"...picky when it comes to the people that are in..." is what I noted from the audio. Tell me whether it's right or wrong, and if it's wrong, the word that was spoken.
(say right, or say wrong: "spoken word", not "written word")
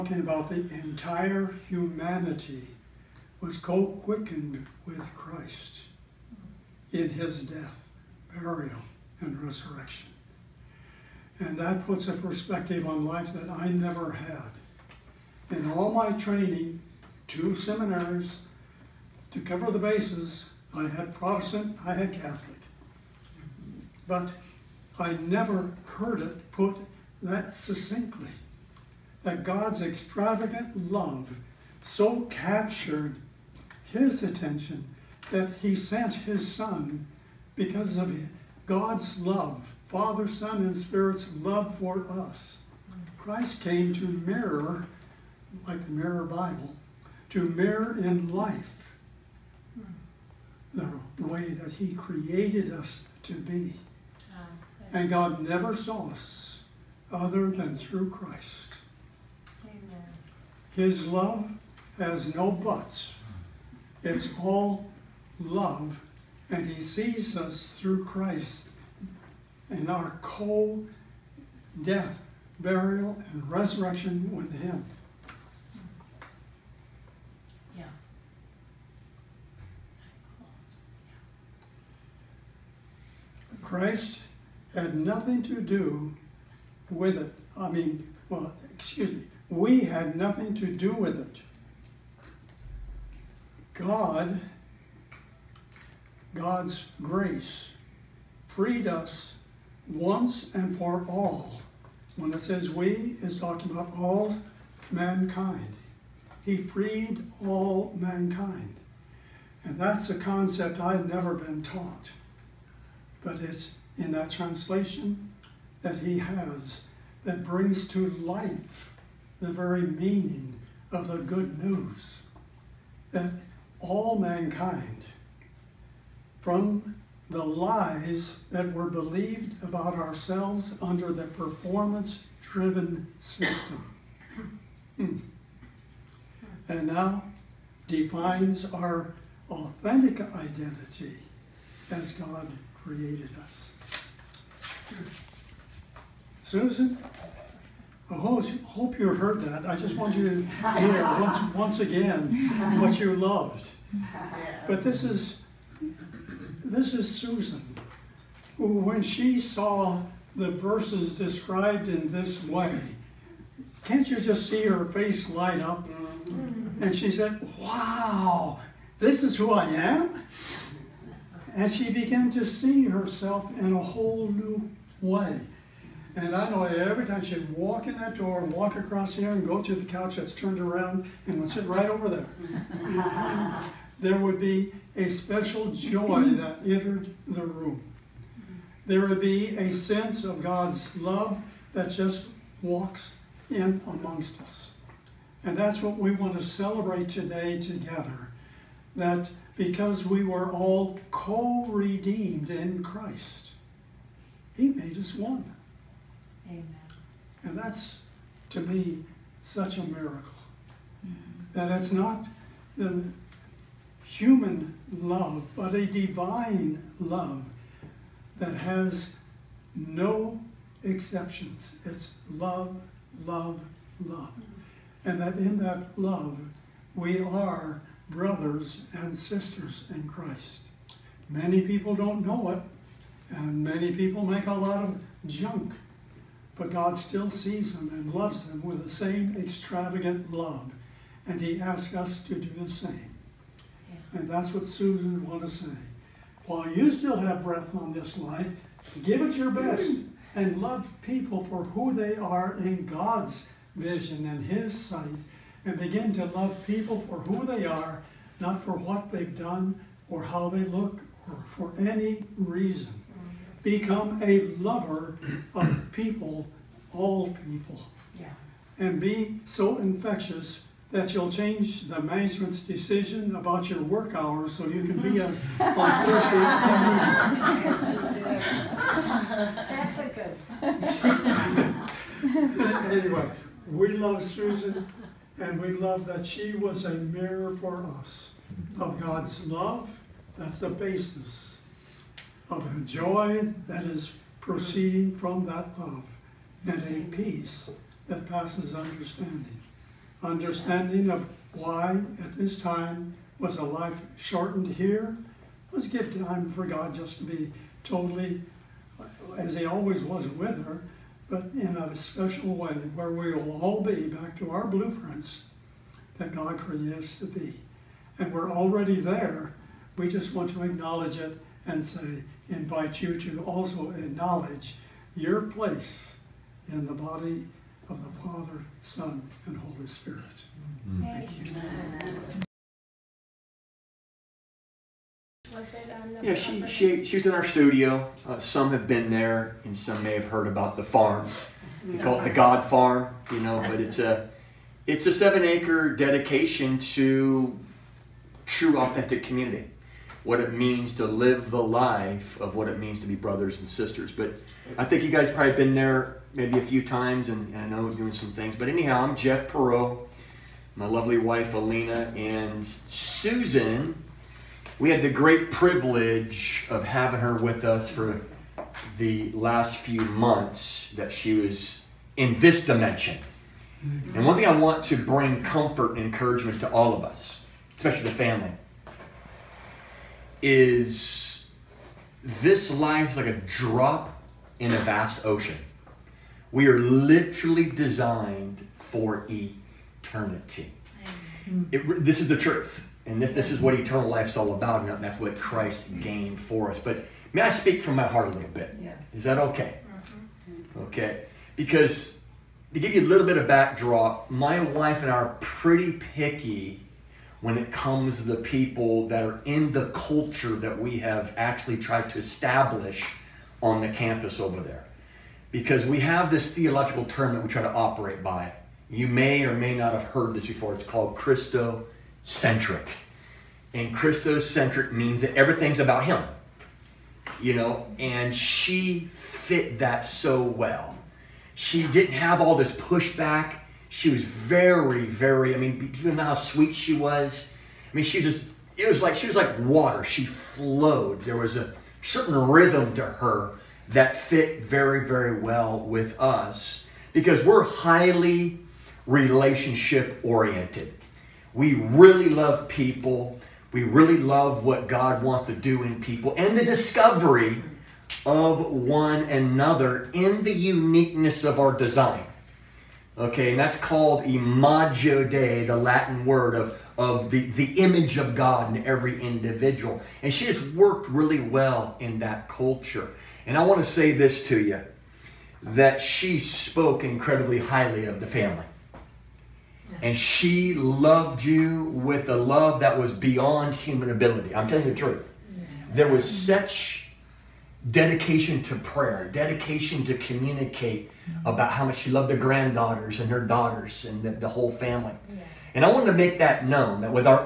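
right.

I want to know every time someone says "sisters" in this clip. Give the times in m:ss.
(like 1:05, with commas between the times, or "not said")
3:49, 5:53.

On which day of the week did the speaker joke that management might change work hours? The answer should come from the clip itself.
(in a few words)
Thursdays.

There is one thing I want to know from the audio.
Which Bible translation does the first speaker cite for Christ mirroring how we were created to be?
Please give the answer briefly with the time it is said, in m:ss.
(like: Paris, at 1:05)
Mirror Bible, at 0:45.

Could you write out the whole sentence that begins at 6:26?
We are literally designed for eternity.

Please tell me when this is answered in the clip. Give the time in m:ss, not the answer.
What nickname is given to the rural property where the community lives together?
5:42.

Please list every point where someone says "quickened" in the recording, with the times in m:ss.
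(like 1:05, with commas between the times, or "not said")
0:03.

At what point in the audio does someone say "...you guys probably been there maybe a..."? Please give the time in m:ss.
5:55.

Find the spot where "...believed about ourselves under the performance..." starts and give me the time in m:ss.
2:08.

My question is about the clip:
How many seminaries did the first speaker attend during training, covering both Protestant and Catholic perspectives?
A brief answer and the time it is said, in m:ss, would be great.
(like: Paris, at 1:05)
2, at 0:17.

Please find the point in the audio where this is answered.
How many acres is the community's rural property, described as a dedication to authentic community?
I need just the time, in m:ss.
5:45.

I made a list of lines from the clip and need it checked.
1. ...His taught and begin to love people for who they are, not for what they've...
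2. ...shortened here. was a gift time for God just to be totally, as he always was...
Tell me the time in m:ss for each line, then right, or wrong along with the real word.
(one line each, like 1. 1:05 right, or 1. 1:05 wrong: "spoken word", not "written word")
1. 4:14 wrong: "sight", not "taught"
2. 5:04 right.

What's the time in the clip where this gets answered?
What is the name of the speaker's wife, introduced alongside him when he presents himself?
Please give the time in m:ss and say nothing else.
6:01.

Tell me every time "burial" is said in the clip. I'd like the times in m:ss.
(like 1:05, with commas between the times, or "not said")
0:08, 1:12.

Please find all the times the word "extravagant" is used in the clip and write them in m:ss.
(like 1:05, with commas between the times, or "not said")
0:29, 3:59.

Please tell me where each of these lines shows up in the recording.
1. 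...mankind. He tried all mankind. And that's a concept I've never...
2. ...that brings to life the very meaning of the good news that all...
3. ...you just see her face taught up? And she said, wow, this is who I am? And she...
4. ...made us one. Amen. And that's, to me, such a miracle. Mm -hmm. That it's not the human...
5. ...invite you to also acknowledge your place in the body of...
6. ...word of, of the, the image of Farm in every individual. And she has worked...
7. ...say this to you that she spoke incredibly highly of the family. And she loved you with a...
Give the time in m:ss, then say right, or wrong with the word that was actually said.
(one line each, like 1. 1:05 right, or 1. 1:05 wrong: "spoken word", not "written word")
1. 1:44 wrong: "freed", not "tried"
2. 1:57 right
3. 2:44 wrong: "light", not "taught"
4. 3:24 right
5. 5:22 right
6. 7:46 wrong: "God", not "Farm"
7. 7:53 right.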